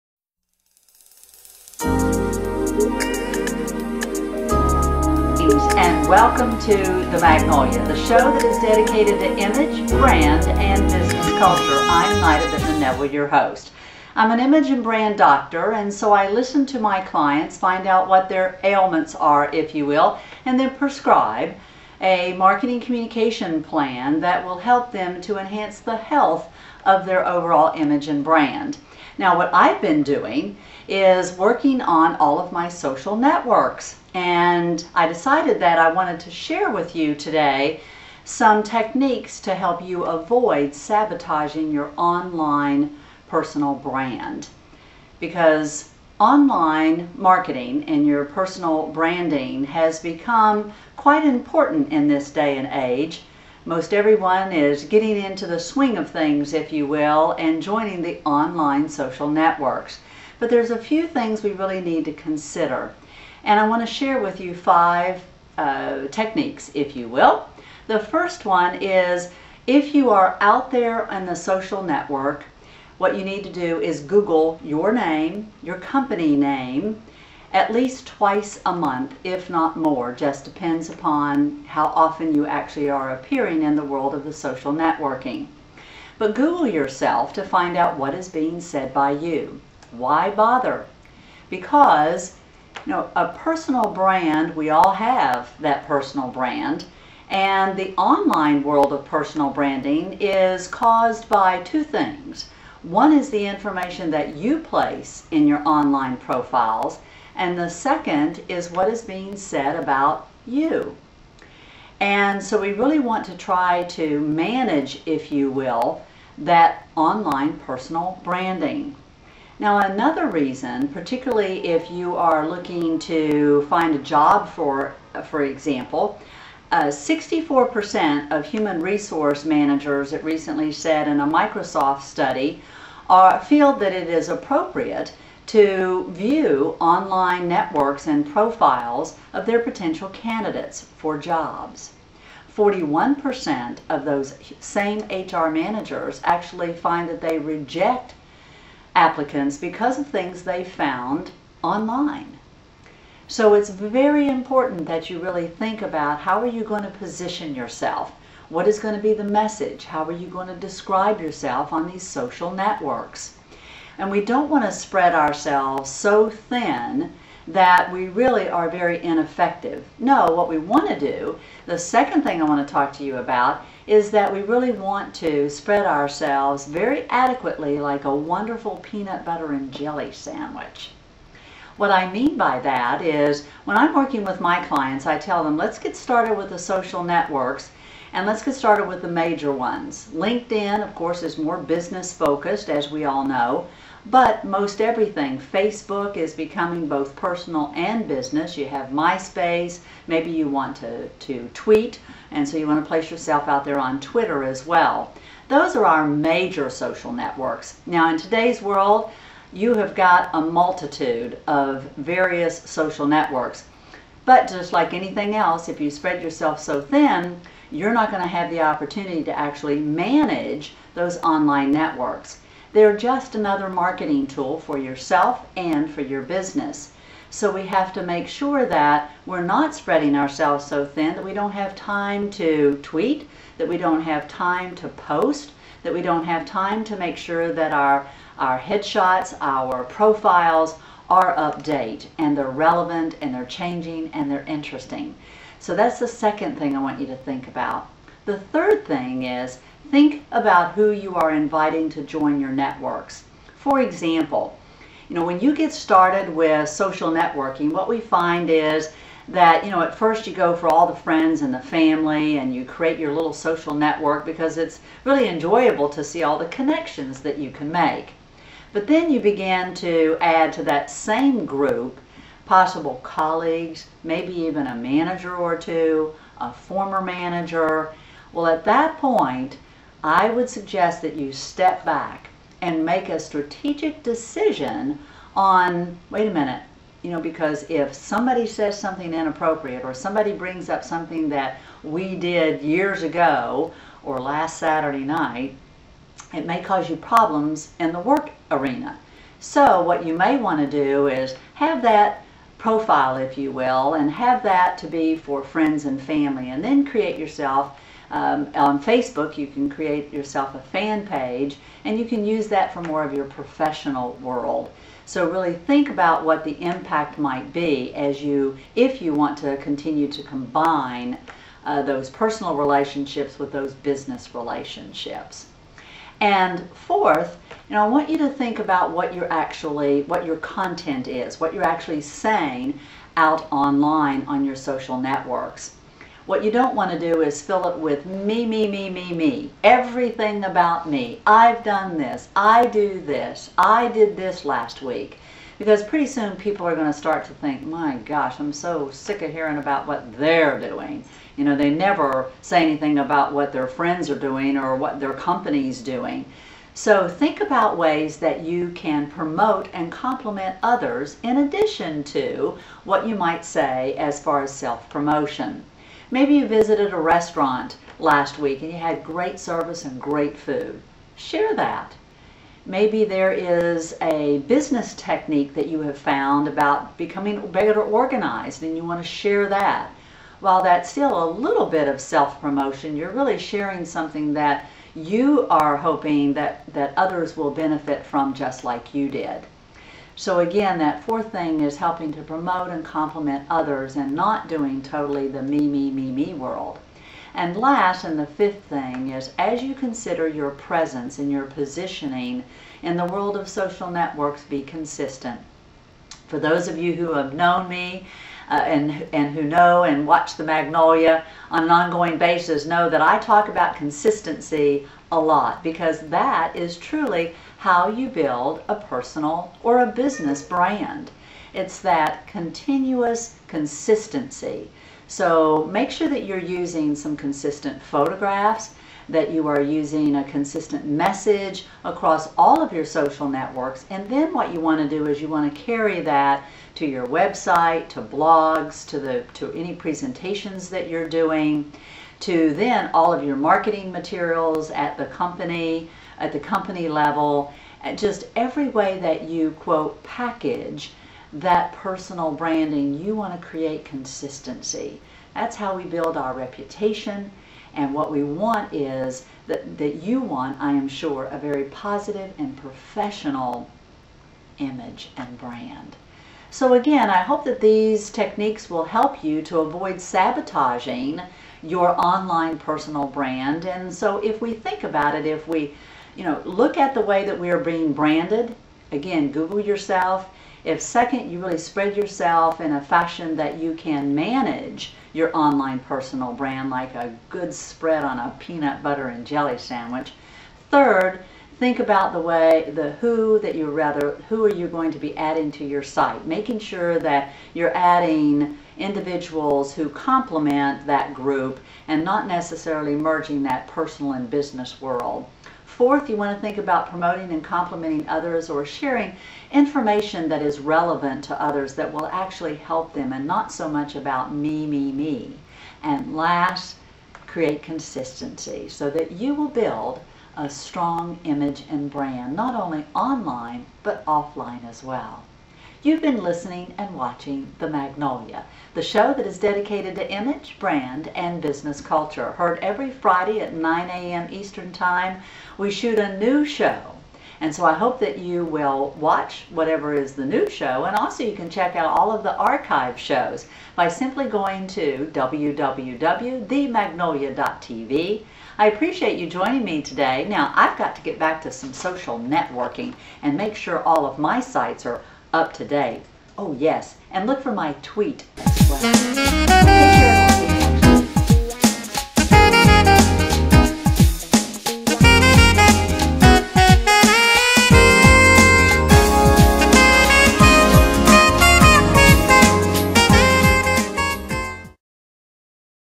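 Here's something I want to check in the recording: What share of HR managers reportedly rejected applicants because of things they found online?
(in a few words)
41%.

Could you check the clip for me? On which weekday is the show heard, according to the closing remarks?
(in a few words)
Friday.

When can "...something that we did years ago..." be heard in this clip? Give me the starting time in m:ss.
4:50.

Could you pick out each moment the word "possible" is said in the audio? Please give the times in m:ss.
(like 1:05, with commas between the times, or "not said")
4:32.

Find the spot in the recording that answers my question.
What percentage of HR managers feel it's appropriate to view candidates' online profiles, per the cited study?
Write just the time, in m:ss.
2:06.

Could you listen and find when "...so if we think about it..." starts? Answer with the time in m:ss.
7:53.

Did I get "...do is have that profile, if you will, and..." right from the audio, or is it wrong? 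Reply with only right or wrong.
right.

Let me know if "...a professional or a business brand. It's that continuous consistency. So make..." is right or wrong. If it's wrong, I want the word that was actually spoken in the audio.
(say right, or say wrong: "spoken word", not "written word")
wrong: "personal", not "professional".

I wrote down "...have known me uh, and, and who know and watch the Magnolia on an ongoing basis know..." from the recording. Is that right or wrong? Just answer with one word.
right.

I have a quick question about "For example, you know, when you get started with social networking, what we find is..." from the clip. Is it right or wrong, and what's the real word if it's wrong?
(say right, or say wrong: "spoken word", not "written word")
right.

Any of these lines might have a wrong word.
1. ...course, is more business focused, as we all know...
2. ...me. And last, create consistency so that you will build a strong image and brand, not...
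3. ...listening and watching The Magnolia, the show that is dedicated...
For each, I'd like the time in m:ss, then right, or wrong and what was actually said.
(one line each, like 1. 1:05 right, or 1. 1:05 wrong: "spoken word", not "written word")
1. 3:10 right
2. 8:34 right
3. 8:46 right.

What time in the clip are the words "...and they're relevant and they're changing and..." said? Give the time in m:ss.
4:02.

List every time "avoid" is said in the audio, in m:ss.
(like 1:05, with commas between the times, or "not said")
0:40, 7:49.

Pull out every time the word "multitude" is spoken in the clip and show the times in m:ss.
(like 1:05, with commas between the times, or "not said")
3:30.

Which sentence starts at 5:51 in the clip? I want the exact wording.
You know, they never say anything about what their friends are doing or what their company's doing.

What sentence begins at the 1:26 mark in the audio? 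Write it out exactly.
But Google yourself to find out what is being said by you.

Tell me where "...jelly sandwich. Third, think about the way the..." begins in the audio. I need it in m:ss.
8:09.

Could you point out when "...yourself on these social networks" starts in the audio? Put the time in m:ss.
2:41.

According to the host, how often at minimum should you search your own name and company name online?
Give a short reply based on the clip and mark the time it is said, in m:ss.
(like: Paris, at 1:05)
twice a month, at 1:18.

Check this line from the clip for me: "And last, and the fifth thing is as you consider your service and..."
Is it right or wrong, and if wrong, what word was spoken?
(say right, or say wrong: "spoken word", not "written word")
wrong: "presence", not "service".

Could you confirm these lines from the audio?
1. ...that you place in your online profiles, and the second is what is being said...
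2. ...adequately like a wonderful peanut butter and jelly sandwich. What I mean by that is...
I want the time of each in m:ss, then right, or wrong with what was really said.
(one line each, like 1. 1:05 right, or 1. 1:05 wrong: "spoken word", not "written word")
1. 1:44 right
2. 2:57 right.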